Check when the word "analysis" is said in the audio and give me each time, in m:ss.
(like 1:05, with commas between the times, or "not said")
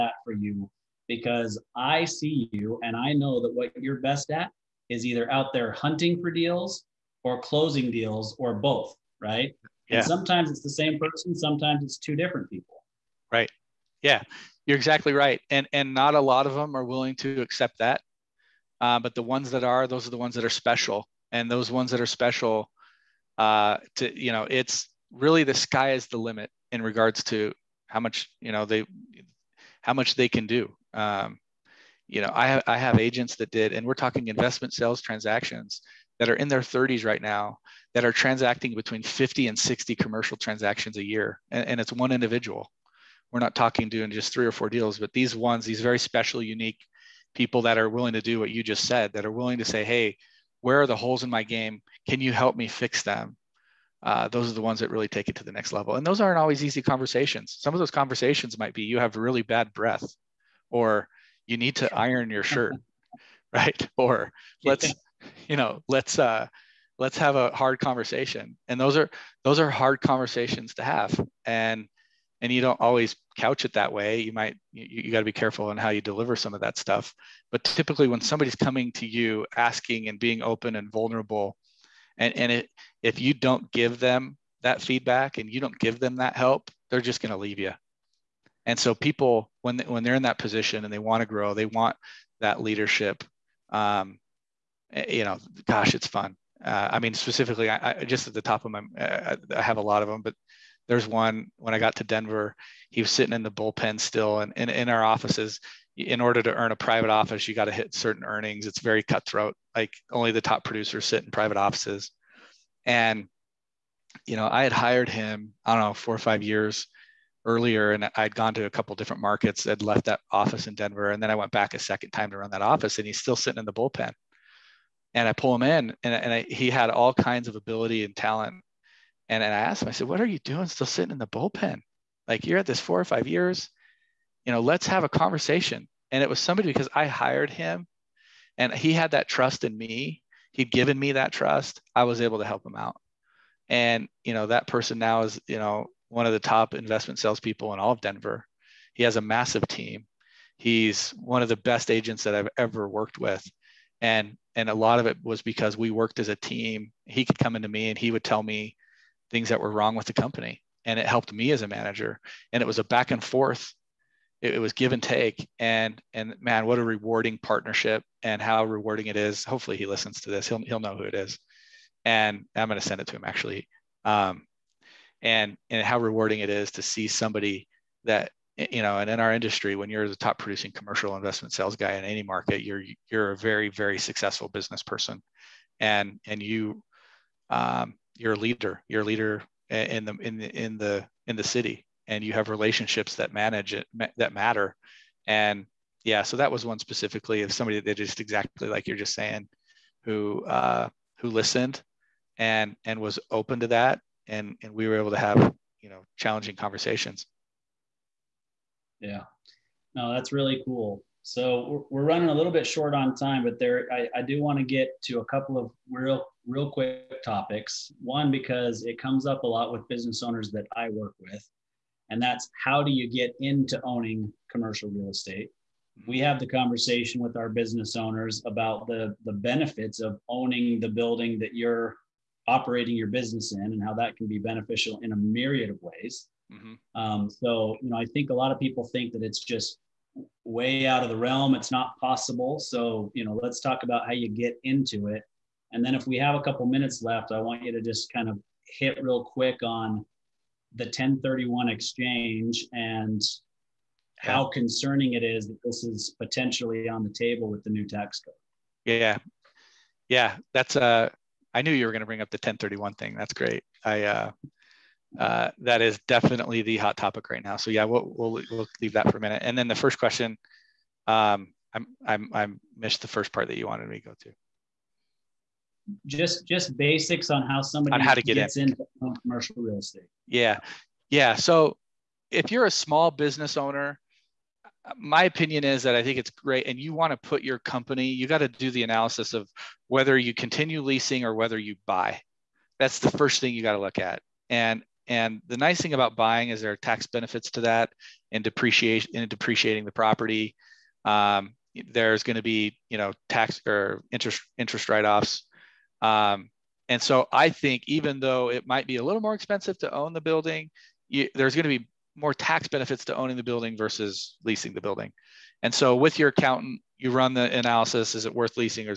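4:48, 5:17.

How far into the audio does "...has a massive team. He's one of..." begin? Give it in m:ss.
2:29.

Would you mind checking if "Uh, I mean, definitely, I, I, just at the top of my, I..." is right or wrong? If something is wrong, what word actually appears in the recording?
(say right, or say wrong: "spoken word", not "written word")
wrong: "specifically", not "definitely".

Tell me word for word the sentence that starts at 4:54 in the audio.
And and the nice thing about buying is there are tax benefits to that and depreciation in depreciating the property.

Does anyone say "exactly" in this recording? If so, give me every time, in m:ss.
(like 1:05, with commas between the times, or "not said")
0:14, 3:18.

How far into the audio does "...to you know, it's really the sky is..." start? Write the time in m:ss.
0:23.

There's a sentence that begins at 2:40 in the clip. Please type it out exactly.
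And it helped me as a manager.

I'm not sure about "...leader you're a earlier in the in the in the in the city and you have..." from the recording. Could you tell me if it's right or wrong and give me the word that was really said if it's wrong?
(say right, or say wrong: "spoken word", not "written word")
wrong: "leader", not "earlier".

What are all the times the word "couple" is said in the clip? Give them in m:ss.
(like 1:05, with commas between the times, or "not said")
1:58, 3:35, 4:06.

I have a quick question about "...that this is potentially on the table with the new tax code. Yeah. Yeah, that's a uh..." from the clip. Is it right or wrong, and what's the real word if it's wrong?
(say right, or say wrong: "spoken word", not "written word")
right.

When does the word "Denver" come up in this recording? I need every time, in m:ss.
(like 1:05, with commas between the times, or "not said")
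1:42, 2:00, 2:28.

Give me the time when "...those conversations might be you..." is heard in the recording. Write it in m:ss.
0:57.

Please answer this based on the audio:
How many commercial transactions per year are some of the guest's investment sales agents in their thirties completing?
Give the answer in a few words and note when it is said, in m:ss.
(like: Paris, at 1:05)
50 to 60, at 0:38.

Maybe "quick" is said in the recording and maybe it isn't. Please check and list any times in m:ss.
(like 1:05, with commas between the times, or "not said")
3:36, 4:09.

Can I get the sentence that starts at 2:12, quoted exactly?
Like you're at this four or five years, you know, let's have a conversation.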